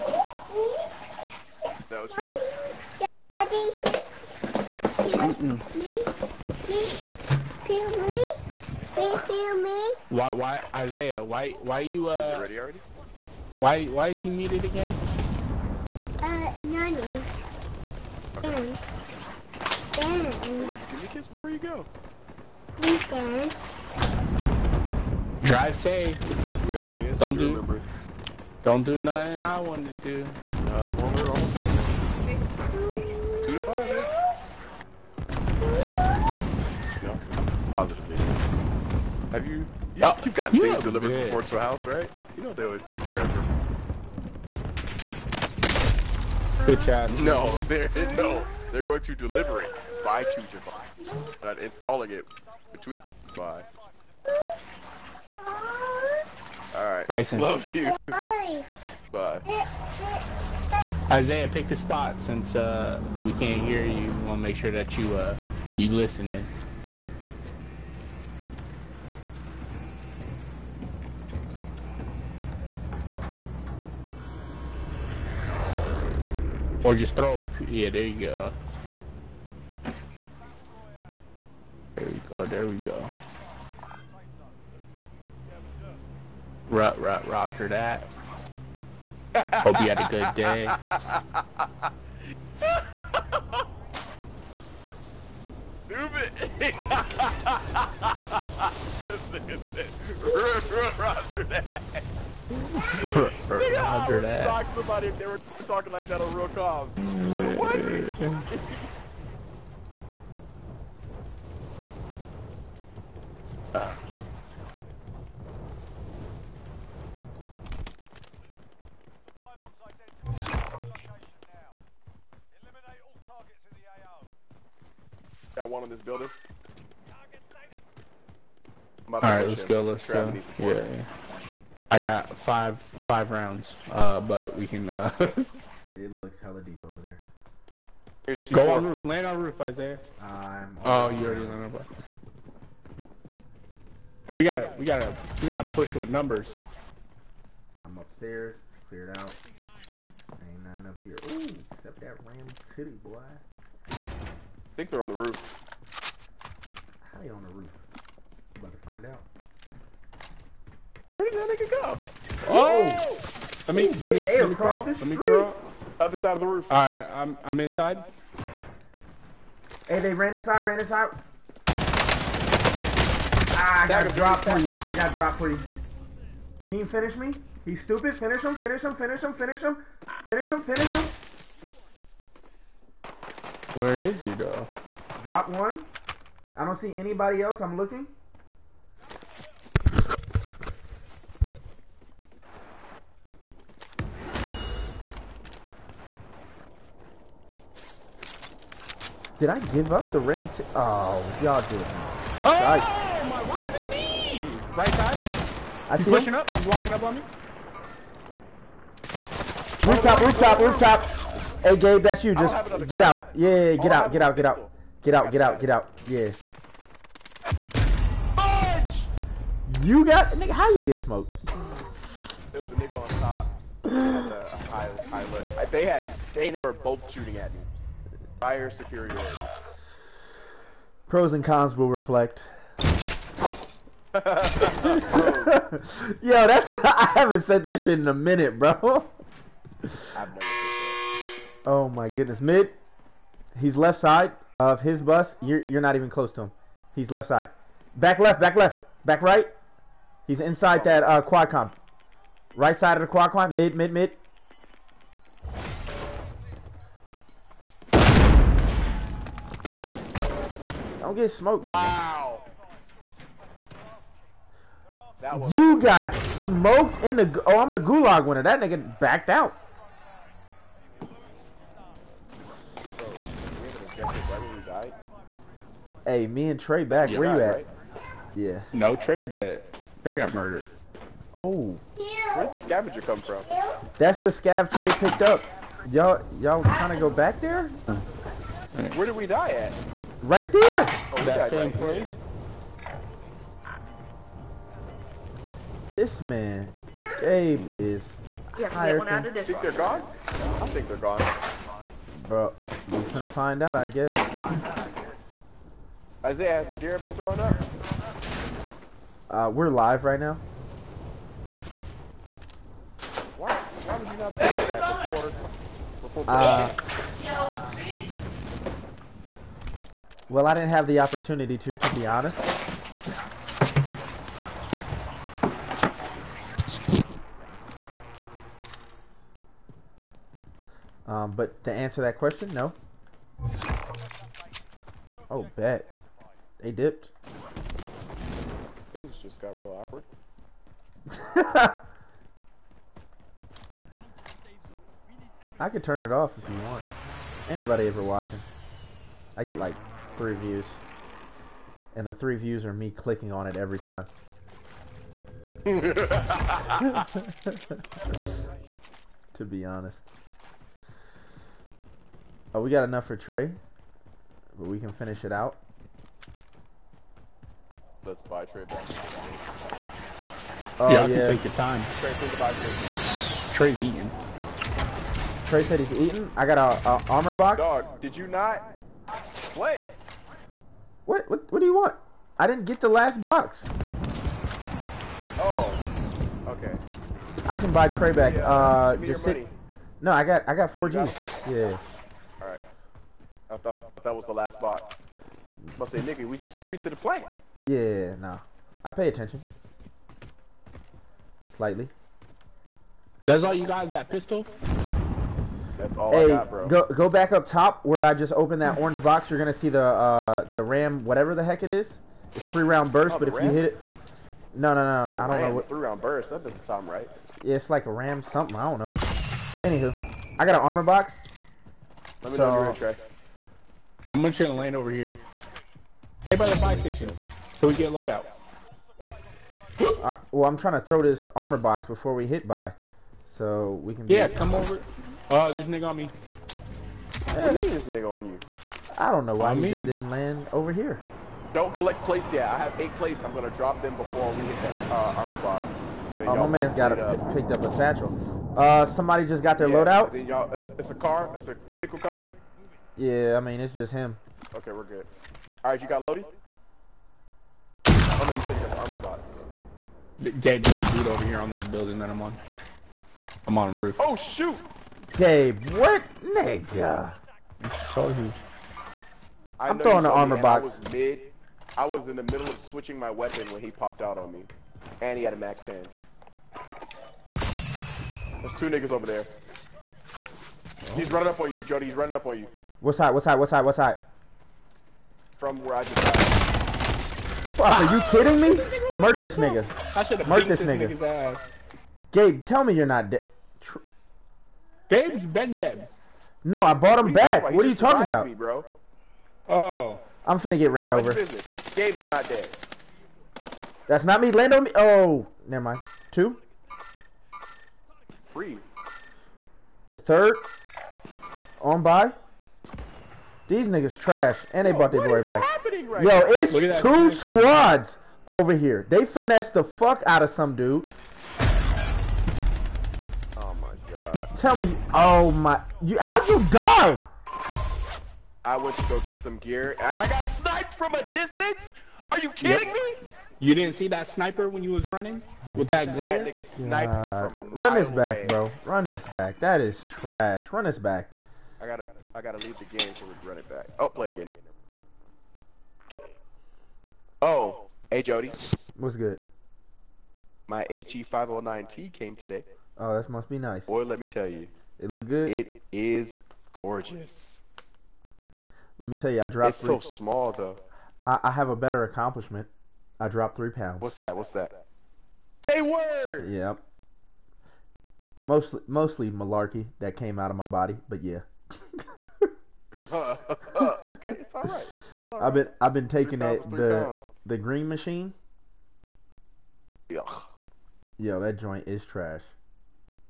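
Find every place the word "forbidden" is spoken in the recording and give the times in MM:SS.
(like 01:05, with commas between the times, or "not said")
not said.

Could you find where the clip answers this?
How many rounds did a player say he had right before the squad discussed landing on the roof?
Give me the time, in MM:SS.
02:12.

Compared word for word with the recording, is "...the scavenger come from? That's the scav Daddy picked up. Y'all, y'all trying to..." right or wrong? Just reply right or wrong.
wrong.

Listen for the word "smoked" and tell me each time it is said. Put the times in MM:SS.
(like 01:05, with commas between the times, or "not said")
03:40, 04:21, 04:26.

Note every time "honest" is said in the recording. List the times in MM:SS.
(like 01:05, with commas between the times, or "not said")
05:22, 05:59.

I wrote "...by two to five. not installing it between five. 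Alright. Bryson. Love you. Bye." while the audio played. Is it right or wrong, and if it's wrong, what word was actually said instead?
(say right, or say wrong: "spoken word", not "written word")
right.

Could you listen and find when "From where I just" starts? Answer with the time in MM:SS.
08:05.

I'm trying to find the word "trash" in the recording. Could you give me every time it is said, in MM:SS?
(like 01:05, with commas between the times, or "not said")
08:33, 08:59, 09:41.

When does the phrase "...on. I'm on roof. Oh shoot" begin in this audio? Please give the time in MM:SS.
07:42.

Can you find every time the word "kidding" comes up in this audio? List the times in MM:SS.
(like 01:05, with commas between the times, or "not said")
08:08, 08:52.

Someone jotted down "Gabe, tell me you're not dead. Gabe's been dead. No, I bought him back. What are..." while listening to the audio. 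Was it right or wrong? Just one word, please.
right.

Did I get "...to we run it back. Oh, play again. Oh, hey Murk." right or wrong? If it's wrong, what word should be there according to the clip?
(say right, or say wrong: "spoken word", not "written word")
wrong: "Jodi", not "Murk".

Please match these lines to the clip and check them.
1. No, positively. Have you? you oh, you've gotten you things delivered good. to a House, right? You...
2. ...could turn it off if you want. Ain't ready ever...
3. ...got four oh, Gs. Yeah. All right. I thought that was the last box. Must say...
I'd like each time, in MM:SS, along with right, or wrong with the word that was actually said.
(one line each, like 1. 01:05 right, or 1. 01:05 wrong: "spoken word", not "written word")
1. 00:37 right
2. 05:45 wrong: "nobody", not "ready"
3. 06:30 right.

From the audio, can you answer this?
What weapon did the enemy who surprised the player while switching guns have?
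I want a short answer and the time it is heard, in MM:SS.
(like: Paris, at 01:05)
Mac 10, at 07:55.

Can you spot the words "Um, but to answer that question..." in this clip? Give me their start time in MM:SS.
05:31.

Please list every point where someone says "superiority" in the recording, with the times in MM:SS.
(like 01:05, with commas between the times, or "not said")
03:48.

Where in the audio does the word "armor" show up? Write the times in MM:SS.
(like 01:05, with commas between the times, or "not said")
06:17, 07:00, 07:11, 07:25, 07:38, 07:50.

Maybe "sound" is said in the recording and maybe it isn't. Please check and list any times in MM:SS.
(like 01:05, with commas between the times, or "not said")
06:56.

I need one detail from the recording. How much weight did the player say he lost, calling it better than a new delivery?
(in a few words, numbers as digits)
3 pounds.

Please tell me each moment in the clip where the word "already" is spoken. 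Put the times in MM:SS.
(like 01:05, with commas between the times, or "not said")
00:12, 02:21.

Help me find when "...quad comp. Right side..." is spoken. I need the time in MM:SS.
04:11.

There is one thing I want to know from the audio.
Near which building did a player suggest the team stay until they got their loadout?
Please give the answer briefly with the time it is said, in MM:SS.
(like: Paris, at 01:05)
Fire station, at 07:06.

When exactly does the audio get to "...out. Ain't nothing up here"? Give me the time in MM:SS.
02:29.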